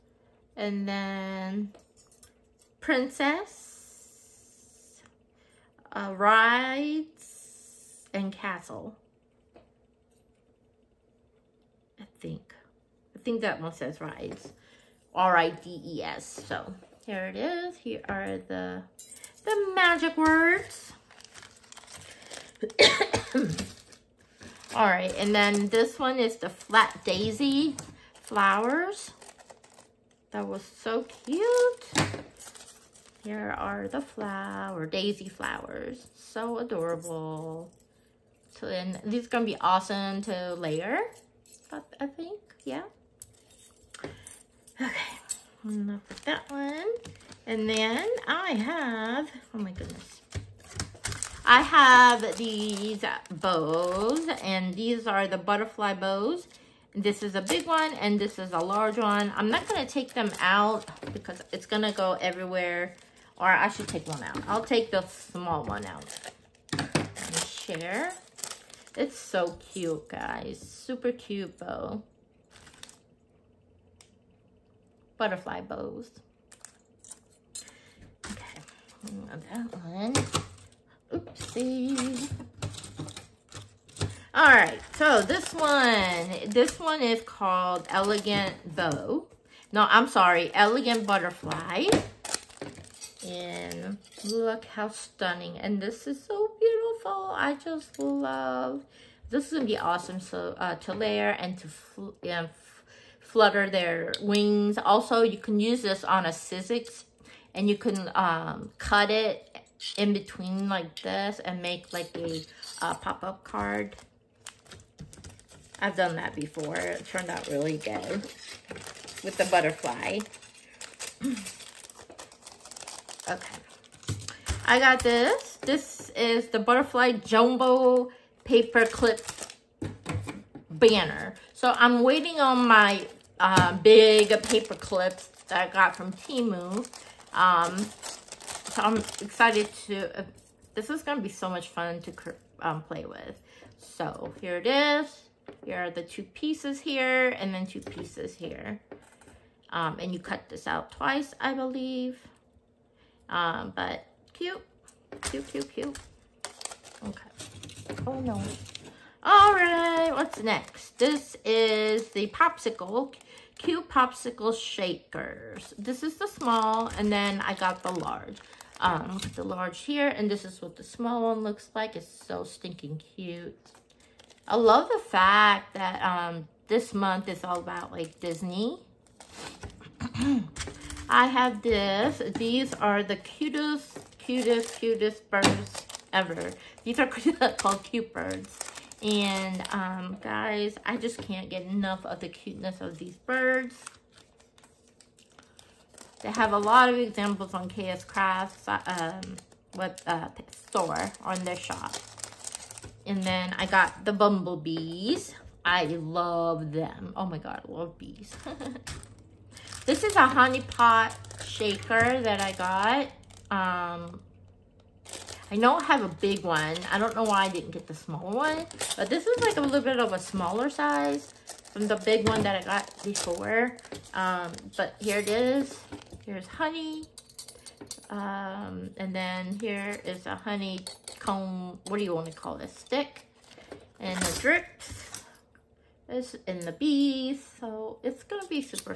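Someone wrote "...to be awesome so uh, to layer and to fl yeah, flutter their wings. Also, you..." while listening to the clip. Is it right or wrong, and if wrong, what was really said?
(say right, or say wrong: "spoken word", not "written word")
right.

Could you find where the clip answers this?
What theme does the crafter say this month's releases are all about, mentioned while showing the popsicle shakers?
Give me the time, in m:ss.
2:58.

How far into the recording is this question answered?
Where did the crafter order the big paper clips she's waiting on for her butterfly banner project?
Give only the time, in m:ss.
2:16.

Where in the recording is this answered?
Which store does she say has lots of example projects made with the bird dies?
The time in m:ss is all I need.
3:17.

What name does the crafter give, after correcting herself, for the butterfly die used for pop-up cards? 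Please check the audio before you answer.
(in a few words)
Elegant Butterfly.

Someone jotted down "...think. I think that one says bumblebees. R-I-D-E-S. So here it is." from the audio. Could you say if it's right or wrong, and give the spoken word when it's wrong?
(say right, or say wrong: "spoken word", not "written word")
wrong: "rides", not "bumblebees".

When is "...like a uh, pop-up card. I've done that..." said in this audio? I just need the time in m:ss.
1:51.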